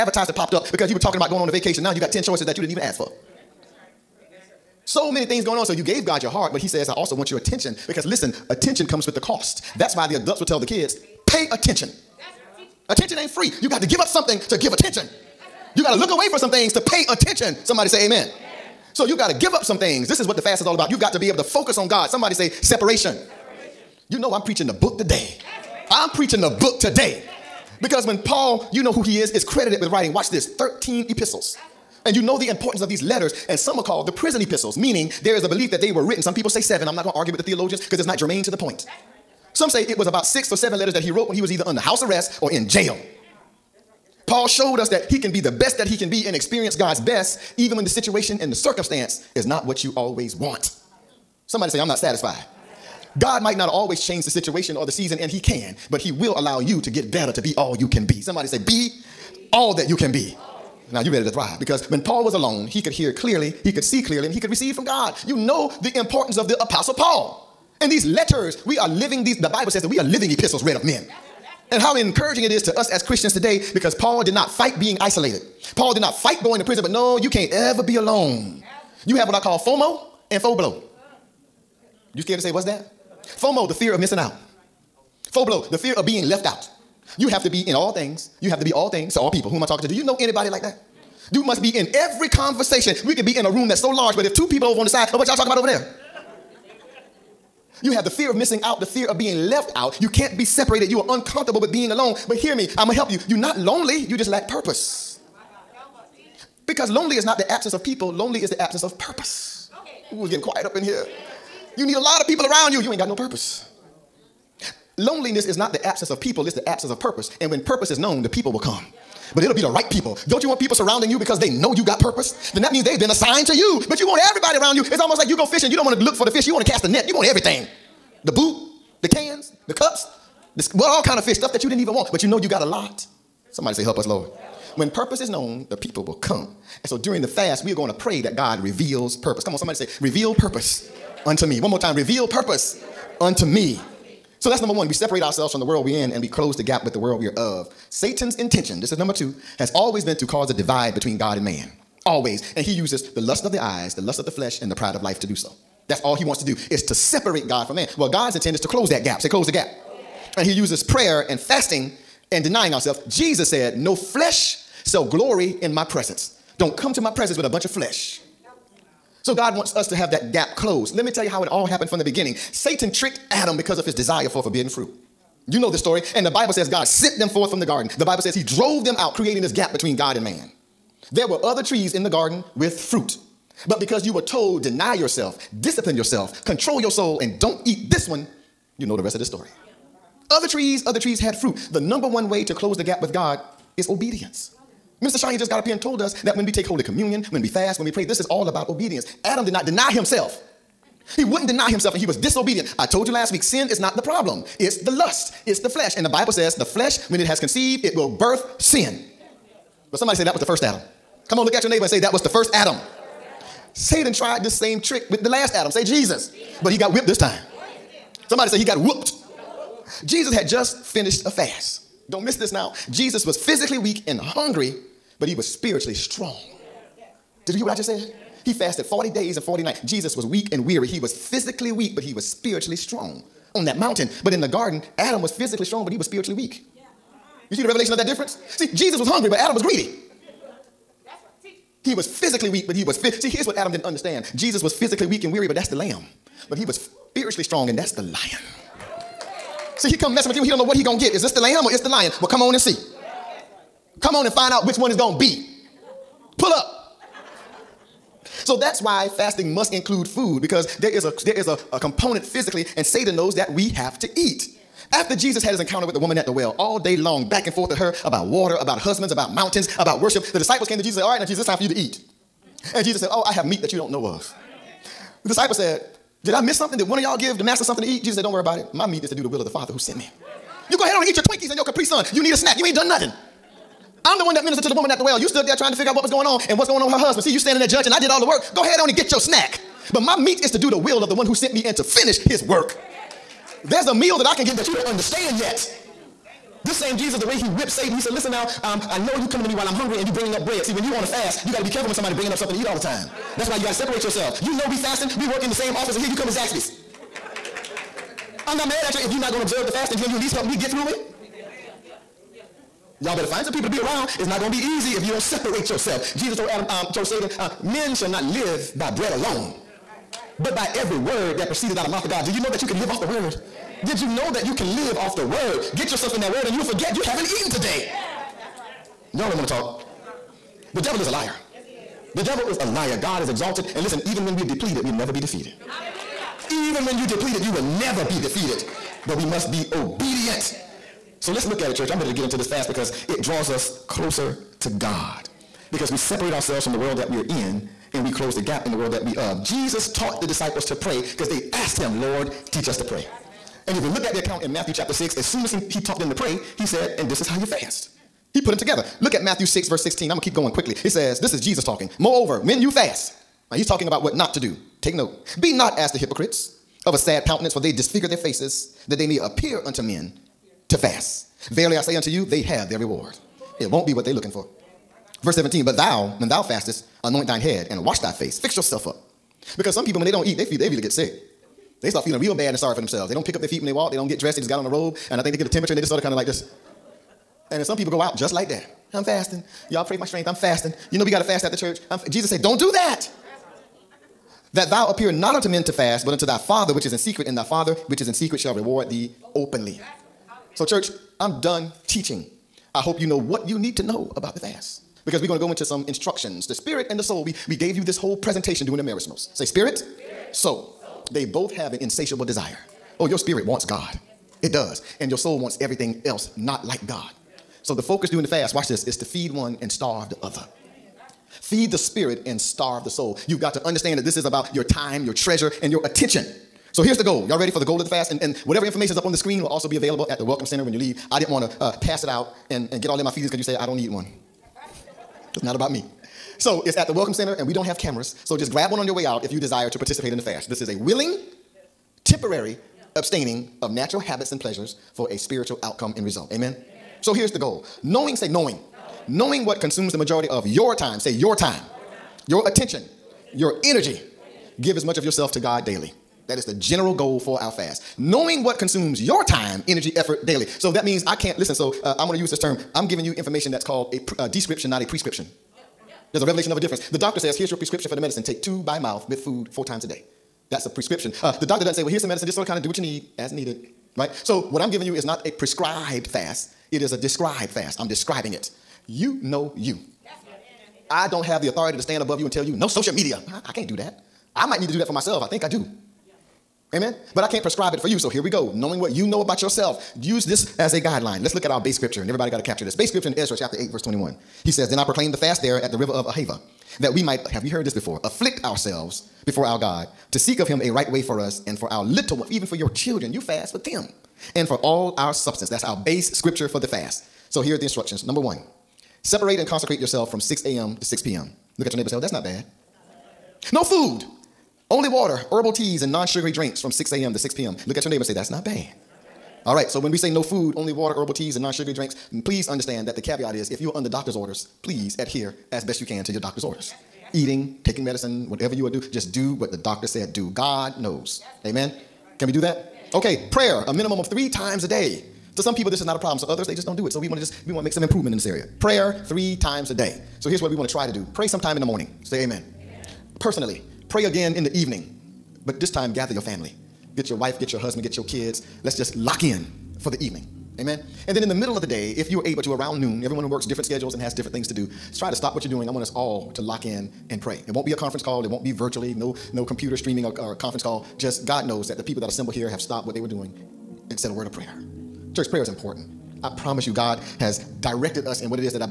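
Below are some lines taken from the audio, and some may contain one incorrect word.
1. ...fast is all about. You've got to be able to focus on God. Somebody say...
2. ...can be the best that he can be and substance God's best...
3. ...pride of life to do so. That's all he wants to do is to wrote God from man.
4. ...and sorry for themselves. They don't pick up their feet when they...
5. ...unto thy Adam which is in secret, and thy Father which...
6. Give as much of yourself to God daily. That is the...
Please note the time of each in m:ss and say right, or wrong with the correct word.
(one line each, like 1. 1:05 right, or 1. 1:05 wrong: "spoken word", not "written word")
1. 0:20 right
2. 0:45 wrong: "experience", not "substance"
3. 2:34 wrong: "separate", not "wrote"
4. 6:22 right
5. 6:36 wrong: "Father", not "Adam"
6. 7:34 right.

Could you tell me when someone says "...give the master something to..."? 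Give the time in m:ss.
4:37.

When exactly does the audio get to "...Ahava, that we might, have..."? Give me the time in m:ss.
8:16.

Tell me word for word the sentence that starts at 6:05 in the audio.
Be not as the hypocrites of a sad countenance, for they disfigure their faces that they may appear unto men to fast.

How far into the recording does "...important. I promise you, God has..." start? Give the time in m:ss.
9:25.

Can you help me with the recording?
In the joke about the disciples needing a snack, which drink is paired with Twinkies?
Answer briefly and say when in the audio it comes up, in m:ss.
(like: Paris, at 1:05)
Capri Sun, at 4:41.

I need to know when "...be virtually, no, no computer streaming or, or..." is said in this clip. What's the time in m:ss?
9:18.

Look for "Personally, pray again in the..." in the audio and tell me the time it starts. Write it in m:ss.
9:03.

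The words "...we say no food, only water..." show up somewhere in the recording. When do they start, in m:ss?
8:39.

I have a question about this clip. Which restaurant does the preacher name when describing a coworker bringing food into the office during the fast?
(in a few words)
Zaxby's.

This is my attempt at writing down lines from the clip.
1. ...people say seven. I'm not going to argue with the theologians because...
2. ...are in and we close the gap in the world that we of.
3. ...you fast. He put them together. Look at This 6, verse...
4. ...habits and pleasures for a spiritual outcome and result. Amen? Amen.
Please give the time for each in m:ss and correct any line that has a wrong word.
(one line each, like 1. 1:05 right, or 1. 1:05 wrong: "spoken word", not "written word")
1. 0:36 right
2. 5:47 right
3. 5:57 wrong: "Matthew", not "This"
4. 7:23 right.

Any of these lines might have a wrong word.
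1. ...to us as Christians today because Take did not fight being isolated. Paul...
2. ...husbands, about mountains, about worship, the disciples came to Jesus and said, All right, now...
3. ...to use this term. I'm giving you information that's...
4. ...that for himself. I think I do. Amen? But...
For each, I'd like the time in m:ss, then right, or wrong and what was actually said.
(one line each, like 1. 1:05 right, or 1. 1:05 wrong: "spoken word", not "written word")
1. 1:12 wrong: "Paul", not "Take"
2. 4:28 right
3. 7:42 right
4. 8:04 wrong: "myself", not "himself".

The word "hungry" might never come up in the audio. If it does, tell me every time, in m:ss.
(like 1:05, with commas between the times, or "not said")
3:44, 3:59, 4:59.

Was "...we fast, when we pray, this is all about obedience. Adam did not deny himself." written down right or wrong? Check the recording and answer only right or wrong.
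right.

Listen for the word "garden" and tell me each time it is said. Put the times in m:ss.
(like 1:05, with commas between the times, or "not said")
2:57, 3:02, 3:54.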